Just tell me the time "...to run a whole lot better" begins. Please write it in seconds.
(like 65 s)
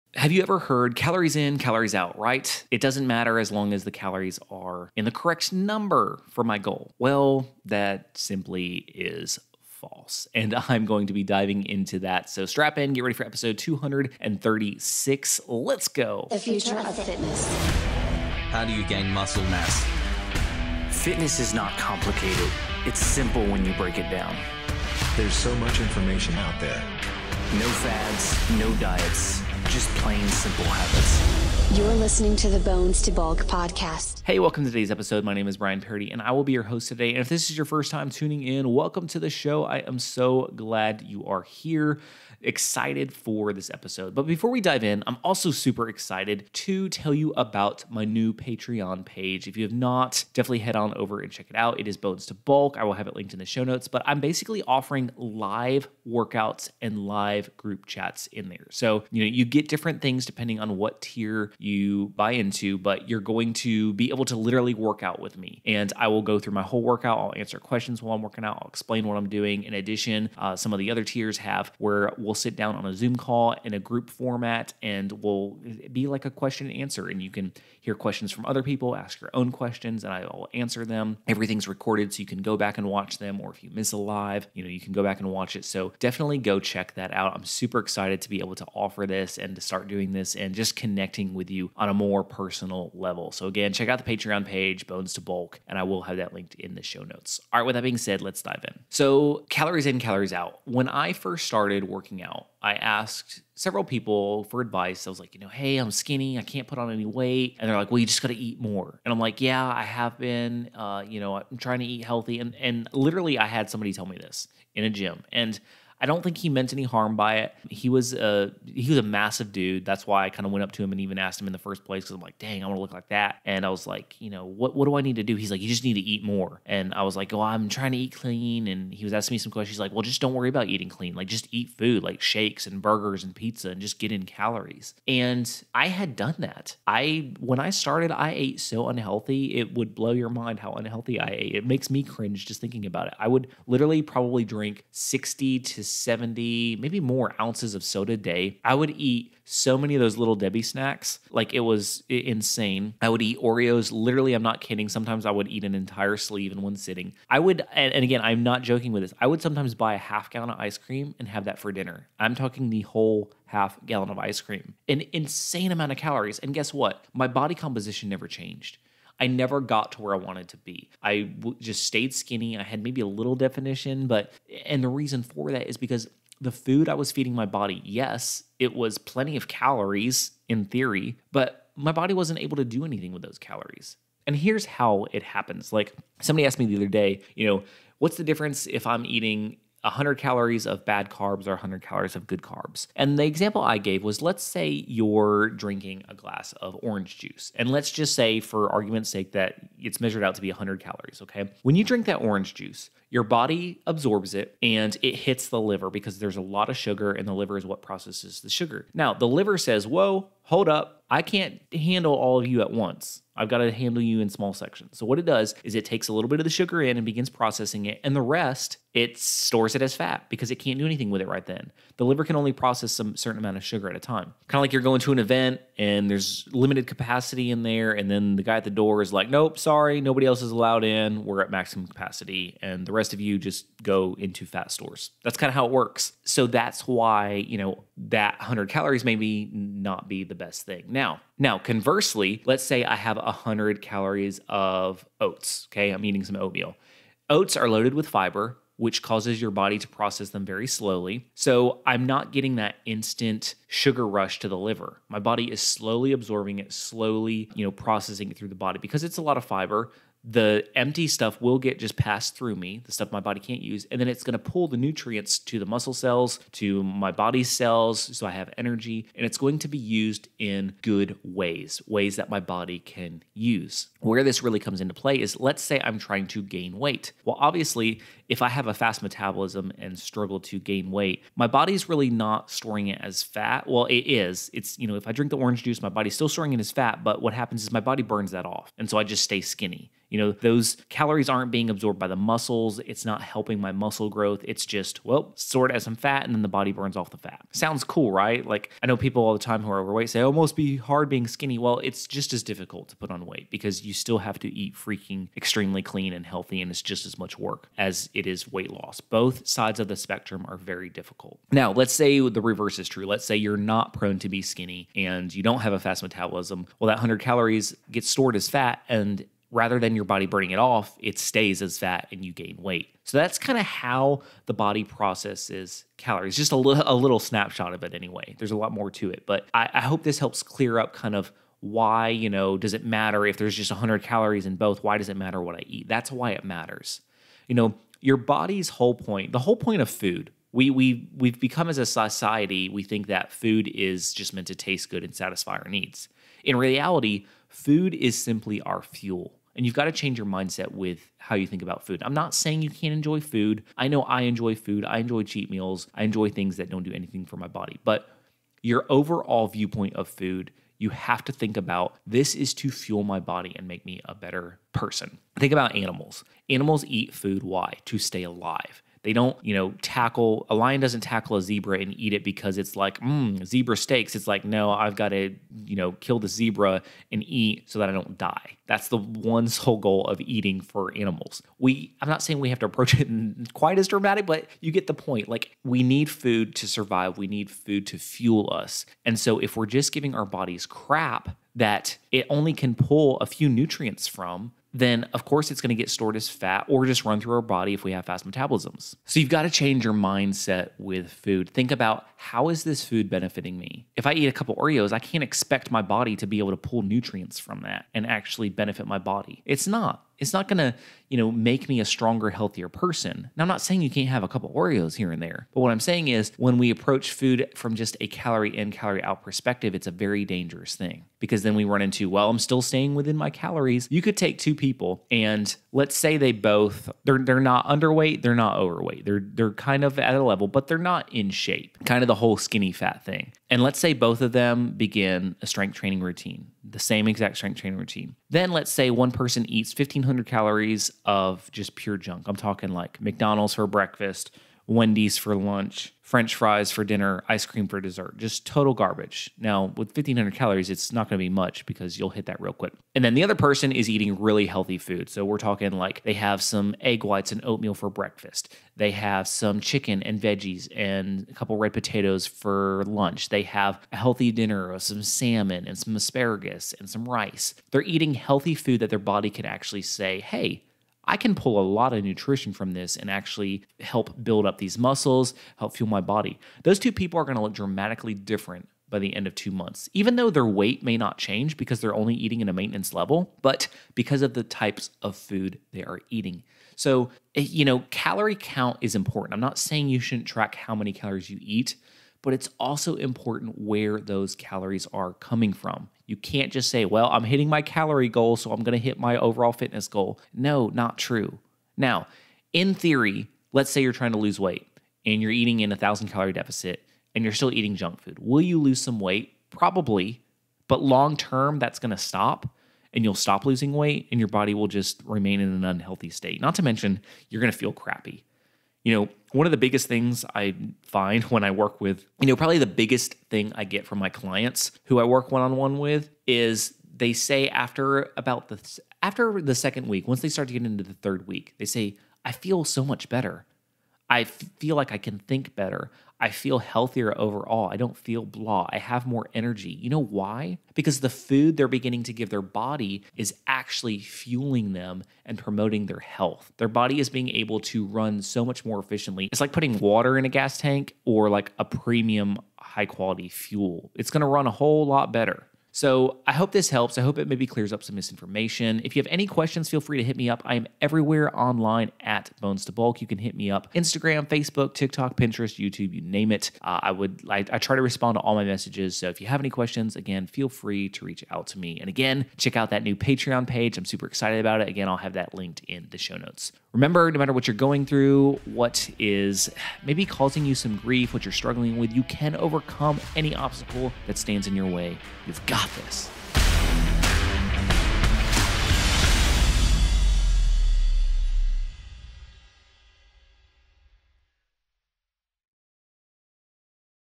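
554 s.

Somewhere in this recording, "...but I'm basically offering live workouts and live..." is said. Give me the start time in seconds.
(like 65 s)
53 s.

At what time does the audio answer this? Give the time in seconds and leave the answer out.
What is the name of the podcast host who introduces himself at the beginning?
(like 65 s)
35 s.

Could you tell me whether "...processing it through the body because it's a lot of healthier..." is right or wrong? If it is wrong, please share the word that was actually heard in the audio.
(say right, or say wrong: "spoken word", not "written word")
wrong: "fiber", not "healthier".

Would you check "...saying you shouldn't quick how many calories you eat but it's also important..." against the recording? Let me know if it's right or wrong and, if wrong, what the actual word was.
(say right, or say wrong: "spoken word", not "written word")
wrong: "track", not "quick".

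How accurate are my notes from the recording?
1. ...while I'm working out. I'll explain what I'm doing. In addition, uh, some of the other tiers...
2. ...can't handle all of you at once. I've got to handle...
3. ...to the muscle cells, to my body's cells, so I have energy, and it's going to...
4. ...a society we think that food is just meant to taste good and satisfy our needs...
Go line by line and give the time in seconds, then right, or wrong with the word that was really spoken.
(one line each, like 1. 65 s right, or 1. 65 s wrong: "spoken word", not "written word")
1. 68 s right
2. 211 s right
3. 265 s right
4. 341 s right.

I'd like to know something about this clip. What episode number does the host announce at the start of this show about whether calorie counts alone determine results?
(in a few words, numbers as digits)
236.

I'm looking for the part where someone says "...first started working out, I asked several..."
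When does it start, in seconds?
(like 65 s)
101 s.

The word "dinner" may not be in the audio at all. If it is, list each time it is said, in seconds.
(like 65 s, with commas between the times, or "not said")
161 s, 446 s, 464 s.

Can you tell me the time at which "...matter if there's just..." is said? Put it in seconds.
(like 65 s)
332 s.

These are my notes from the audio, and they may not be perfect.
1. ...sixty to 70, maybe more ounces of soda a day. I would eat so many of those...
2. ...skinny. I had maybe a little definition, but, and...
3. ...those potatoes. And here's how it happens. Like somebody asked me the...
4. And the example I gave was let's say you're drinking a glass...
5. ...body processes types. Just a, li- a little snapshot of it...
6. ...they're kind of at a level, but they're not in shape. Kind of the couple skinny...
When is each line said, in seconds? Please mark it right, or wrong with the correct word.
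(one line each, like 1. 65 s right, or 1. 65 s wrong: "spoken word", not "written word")
1. 144 s right
2. 172 s right
3. 183 s wrong: "calories", not "potatoes"
4. 192 s right
5. 324 s wrong: "calories", not "types"
6. 429 s wrong: "whole", not "couple".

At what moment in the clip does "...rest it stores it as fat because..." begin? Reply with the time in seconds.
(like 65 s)
218 s.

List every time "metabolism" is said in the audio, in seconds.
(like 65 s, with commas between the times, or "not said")
279 s, 316 s, 398 s.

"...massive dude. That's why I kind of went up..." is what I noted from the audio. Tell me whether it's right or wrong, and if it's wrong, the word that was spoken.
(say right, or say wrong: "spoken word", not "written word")
right.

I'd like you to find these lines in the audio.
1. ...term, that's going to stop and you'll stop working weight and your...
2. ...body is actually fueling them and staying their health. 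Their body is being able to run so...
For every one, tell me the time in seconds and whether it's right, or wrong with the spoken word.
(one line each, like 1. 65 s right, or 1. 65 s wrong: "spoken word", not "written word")
1. 511 s wrong: "losing", not "working"
2. 542 s wrong: "promoting", not "staying".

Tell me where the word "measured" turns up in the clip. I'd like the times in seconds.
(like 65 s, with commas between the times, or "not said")
199 s.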